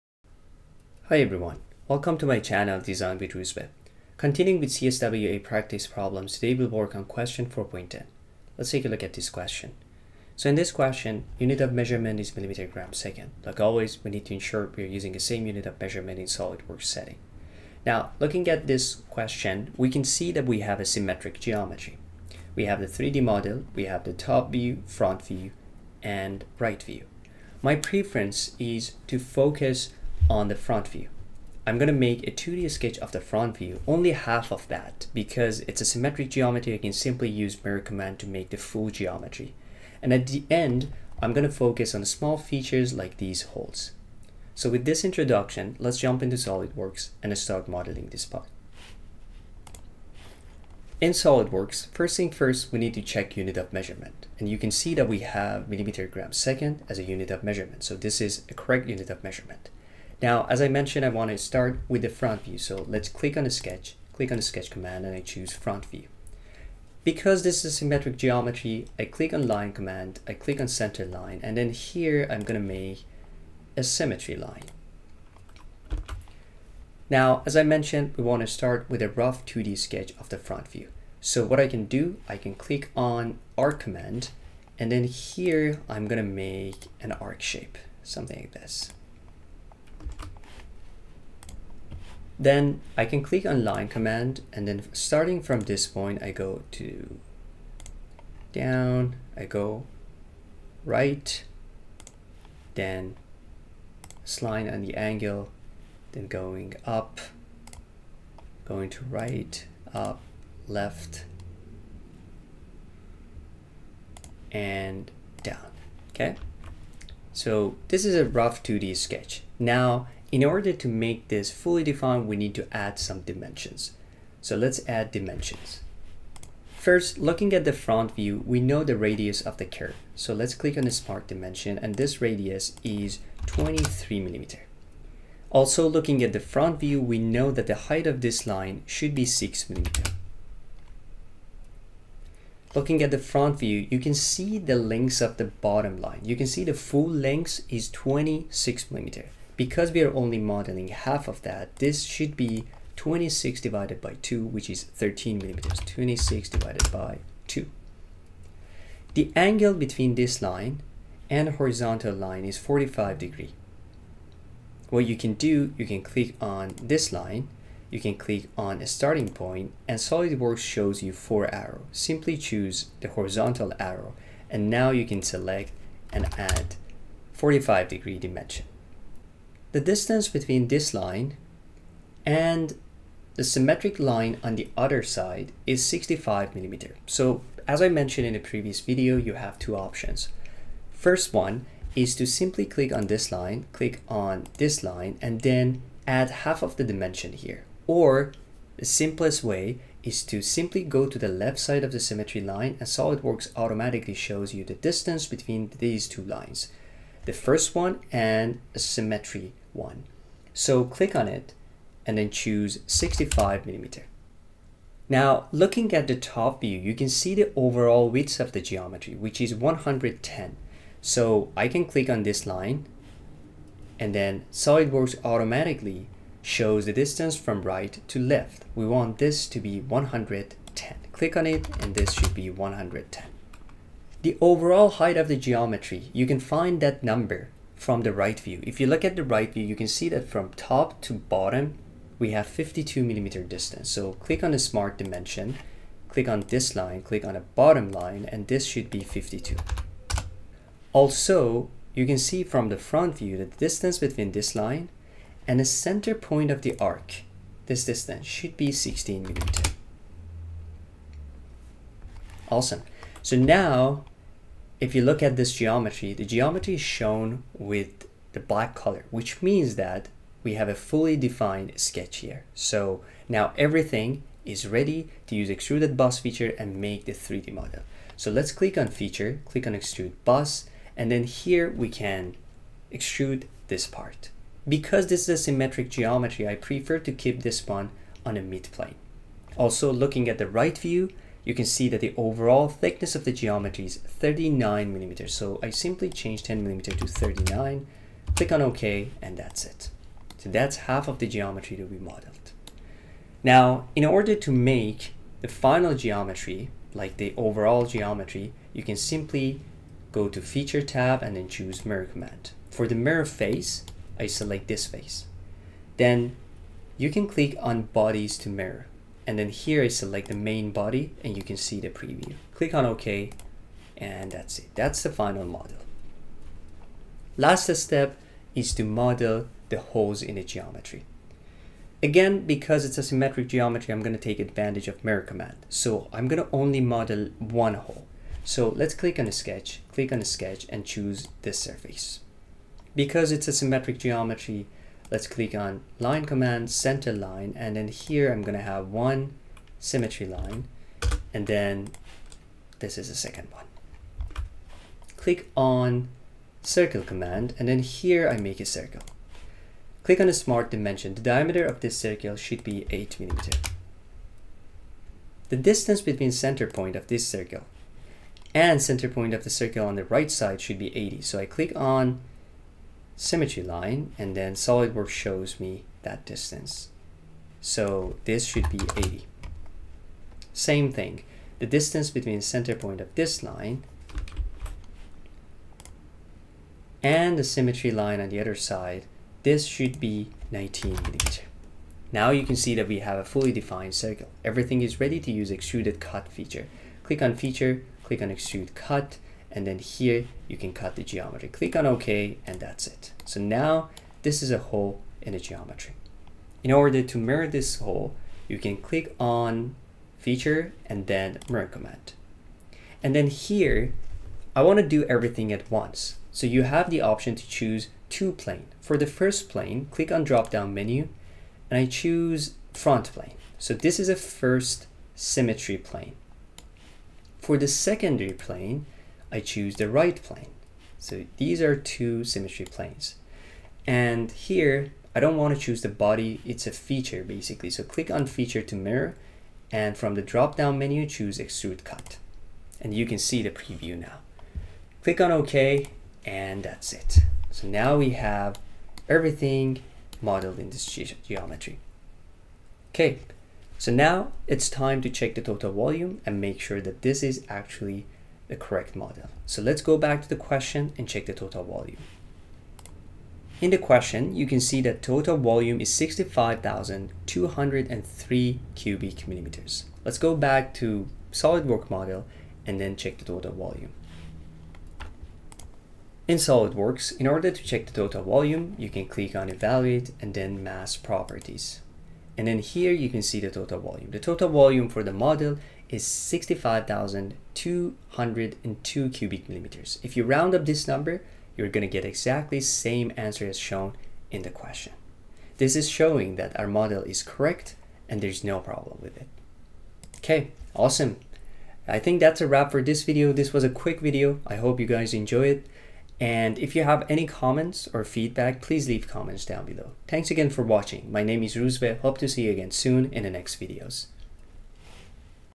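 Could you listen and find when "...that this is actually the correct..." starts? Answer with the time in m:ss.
7:36.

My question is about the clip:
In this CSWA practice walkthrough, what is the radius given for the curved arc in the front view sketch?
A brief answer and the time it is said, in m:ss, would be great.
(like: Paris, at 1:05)
23 mm, at 2:13.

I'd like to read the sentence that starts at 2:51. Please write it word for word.
Simply choose the horizontal arrow, and now you can select and add 45 degree dimension.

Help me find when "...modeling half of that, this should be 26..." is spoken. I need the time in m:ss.
2:30.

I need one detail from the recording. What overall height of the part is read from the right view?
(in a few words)
52 mm.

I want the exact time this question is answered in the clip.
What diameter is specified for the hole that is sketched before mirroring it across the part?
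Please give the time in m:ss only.
6:02.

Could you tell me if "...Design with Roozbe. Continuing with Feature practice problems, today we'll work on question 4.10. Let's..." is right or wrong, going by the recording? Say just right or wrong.
wrong.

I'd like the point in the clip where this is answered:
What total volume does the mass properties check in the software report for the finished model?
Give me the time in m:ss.
8:06.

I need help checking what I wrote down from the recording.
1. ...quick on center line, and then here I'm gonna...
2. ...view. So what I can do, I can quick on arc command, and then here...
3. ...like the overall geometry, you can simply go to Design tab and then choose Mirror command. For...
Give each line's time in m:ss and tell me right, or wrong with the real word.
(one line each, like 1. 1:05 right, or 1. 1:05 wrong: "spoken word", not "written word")
1. 1:10 wrong: "click", not "quick"
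2. 1:20 wrong: "click", not "quick"
3. 5:06 wrong: "Feature", not "Design".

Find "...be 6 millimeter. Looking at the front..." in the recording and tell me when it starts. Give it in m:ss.
2:19.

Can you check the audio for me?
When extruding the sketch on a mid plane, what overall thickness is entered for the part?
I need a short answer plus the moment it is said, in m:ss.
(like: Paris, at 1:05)
39 mm, at 4:53.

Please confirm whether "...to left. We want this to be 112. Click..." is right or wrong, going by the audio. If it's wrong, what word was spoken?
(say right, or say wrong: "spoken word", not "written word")
wrong: "110", not "112".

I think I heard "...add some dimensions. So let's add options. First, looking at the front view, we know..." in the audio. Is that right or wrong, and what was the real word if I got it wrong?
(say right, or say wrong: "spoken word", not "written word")
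wrong: "dimensions", not "options".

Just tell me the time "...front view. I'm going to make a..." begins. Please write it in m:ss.
0:30.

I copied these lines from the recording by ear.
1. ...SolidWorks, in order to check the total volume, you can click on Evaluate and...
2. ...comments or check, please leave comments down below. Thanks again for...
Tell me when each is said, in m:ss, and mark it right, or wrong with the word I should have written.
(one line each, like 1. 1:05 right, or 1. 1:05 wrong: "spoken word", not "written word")
1. 7:56 right
2. 8:27 wrong: "feedback", not "check".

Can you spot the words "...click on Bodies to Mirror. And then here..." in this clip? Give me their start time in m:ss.
5:17.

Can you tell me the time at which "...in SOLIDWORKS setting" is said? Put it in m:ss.
0:16.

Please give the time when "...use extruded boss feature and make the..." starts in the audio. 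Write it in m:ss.
4:35.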